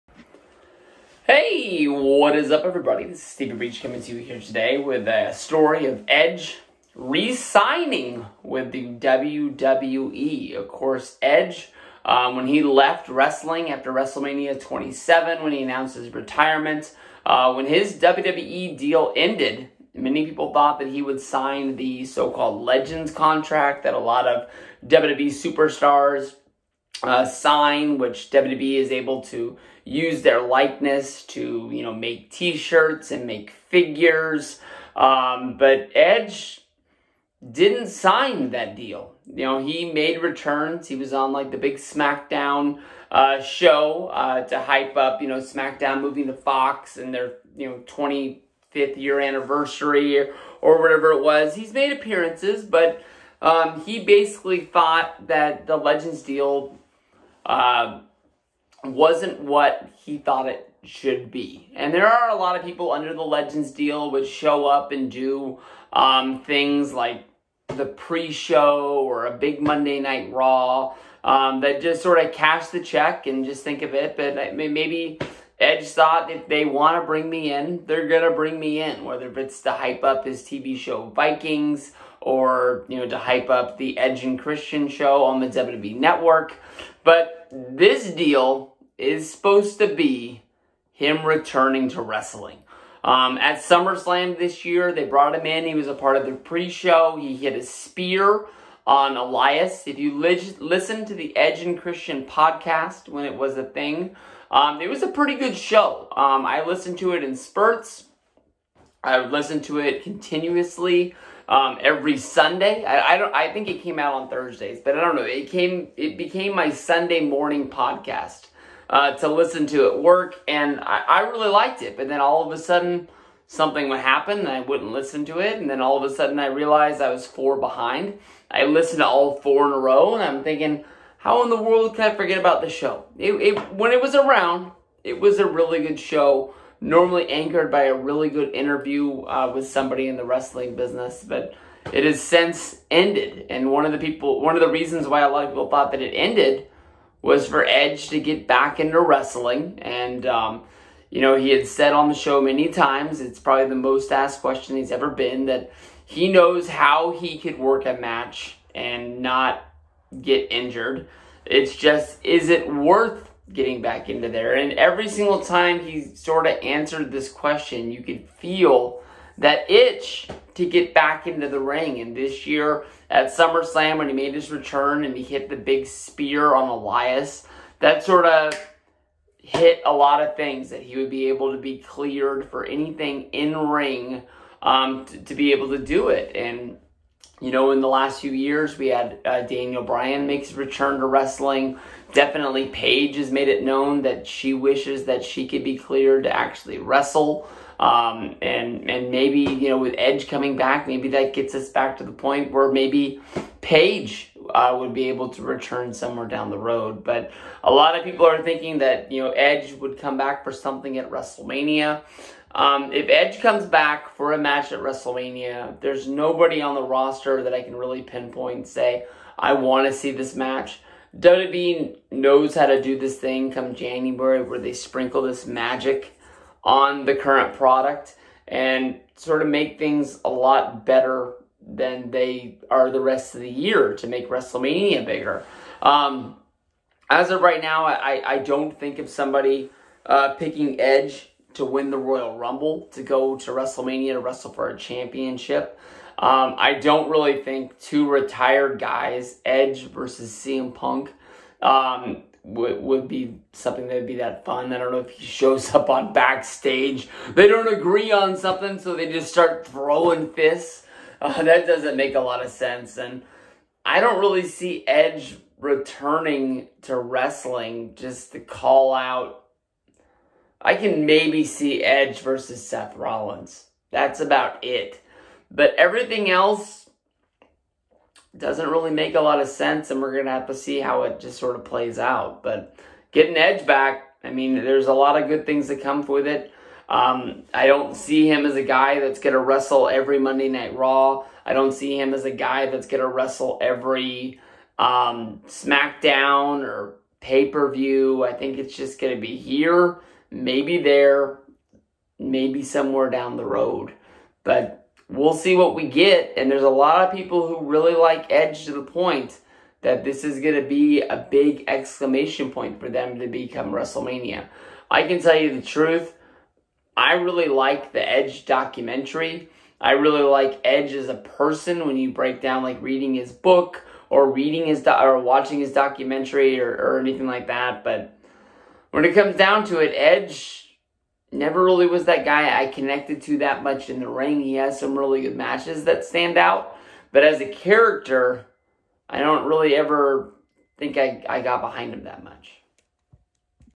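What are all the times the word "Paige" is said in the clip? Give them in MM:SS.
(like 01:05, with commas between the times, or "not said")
03:12, 03:23.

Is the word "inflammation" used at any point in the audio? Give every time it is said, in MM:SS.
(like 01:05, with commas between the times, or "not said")
not said.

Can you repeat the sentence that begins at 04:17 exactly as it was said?
They don't agree on something, so they just start throwing fists.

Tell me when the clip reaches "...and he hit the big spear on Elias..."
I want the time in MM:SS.
02:55.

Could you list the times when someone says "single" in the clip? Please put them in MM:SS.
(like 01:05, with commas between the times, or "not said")
02:45.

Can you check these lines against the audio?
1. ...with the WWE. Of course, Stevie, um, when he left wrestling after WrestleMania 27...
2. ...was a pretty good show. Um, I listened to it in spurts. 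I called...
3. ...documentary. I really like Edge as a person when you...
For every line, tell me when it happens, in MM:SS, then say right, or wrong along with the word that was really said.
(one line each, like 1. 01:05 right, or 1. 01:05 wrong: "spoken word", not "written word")
1. 00:08 wrong: "Edge", not "Stevie"
2. 01:44 wrong: "listened", not "called"
3. 05:18 right.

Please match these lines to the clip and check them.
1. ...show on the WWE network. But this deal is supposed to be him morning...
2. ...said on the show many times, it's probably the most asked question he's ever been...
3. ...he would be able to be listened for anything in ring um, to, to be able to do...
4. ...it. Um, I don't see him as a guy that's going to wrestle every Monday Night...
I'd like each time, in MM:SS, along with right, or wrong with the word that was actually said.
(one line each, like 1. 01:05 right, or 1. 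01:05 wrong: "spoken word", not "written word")
1. 01:24 wrong: "returning", not "morning"
2. 02:31 right
3. 03:00 wrong: "cleared", not "listened"
4. 04:46 right.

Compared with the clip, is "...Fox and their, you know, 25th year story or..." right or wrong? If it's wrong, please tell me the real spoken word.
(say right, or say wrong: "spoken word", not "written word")
wrong: "anniversary", not "story".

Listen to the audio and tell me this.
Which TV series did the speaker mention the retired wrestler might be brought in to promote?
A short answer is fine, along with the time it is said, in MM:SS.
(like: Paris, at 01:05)
Vikings, at 01:21.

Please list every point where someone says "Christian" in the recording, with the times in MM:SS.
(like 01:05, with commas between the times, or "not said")
01:24, 01:41.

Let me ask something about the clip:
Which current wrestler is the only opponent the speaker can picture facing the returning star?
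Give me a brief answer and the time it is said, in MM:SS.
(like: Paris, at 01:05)
Seth Rollins, at 04:32.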